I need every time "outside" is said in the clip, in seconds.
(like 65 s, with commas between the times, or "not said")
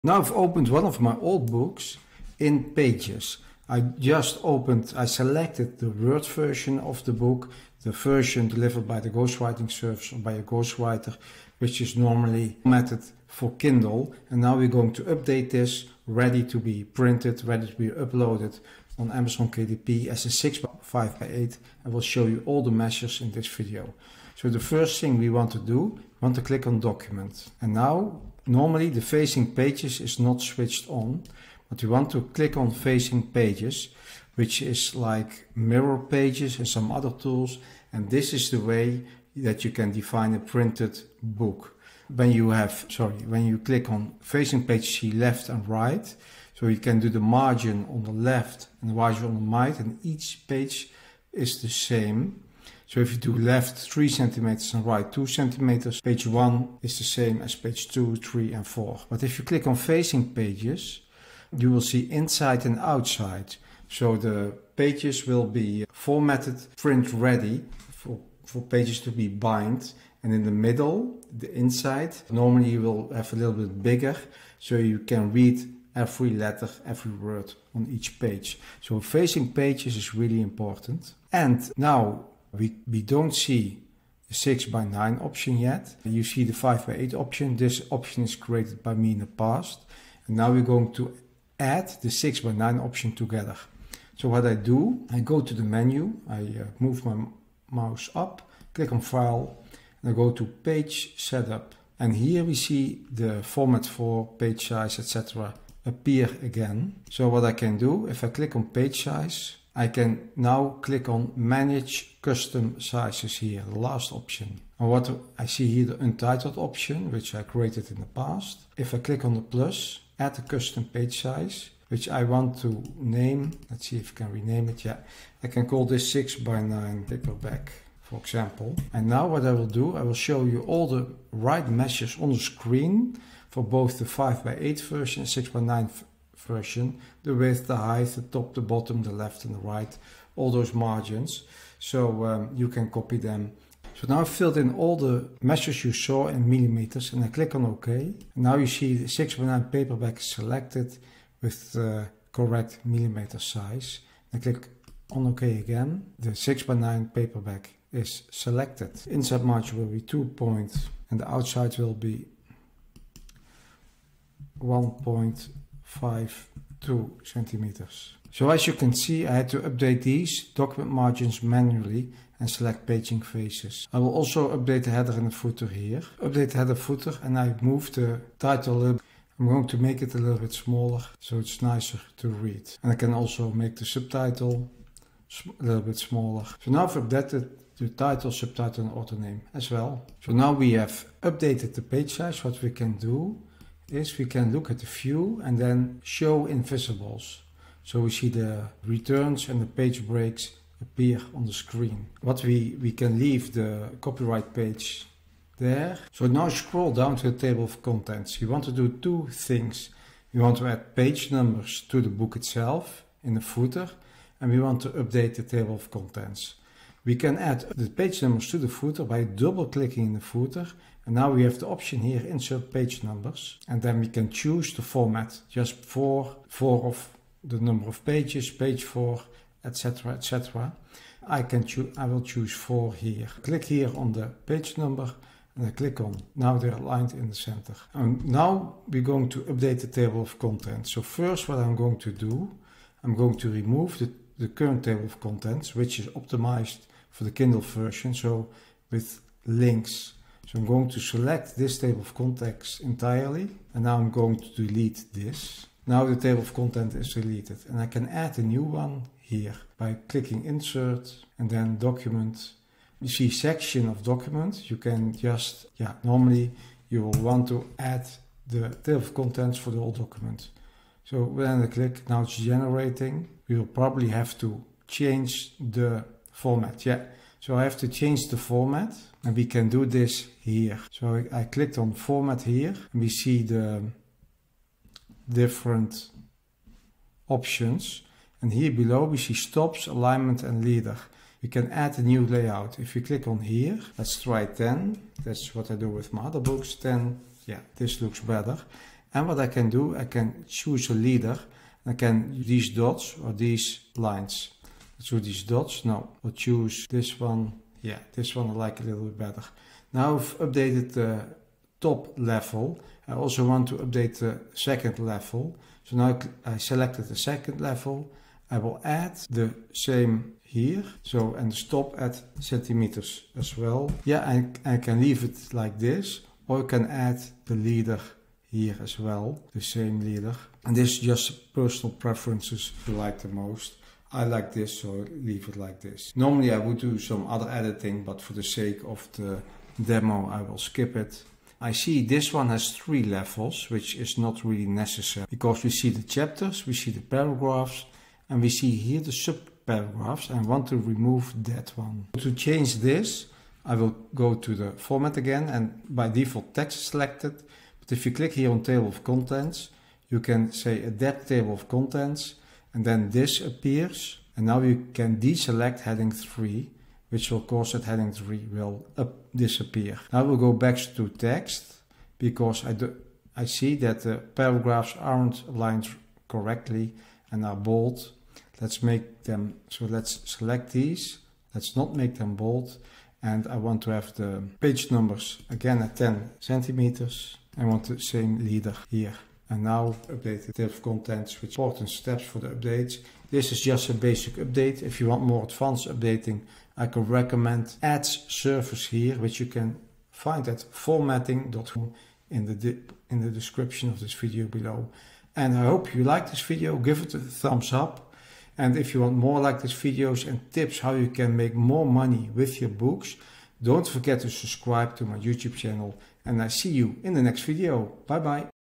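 62 s, 161 s.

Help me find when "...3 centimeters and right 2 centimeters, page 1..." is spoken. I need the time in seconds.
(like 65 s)
53 s.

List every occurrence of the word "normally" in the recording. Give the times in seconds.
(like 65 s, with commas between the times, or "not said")
11 s, 28 s, 72 s, 266 s, 336 s.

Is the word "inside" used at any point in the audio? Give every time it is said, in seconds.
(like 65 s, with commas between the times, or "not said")
62 s, 71 s, 159 s.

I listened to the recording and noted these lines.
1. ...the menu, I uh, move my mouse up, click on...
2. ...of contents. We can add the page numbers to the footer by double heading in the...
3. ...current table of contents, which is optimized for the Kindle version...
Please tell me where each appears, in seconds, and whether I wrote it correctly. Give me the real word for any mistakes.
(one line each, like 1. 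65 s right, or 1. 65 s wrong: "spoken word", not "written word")
1. 95 s right
2. 215 s wrong: "clicking", not "heading"
3. 244 s right.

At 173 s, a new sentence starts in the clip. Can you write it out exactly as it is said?
I will also update the header and the footer here.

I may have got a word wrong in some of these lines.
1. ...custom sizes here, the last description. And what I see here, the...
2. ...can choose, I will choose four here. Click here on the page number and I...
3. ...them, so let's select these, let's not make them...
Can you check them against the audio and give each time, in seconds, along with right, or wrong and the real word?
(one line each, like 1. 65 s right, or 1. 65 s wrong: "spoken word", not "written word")
1. 112 s wrong: "option", not "description"
2. 231 s right
3. 379 s right.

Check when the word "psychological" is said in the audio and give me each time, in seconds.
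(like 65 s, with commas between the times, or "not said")
not said.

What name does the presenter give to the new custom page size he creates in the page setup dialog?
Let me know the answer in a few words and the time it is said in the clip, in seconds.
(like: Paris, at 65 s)
Six by nine paperback, at 126 s.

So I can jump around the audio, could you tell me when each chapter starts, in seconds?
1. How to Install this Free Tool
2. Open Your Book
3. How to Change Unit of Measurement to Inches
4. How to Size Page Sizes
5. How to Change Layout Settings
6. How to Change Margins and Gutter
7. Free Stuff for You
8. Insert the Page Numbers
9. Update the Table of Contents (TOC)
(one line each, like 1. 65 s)
1. 19 s
2. 66 s
3. 87 s
4. 106 s
5. 143 s
6. 164 s
7. 188 s
8. 231 s
9. 250 s.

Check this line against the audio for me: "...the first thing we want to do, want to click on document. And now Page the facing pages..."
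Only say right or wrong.
wrong.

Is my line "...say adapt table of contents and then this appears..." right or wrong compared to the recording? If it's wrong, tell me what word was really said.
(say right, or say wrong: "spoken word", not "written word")
right.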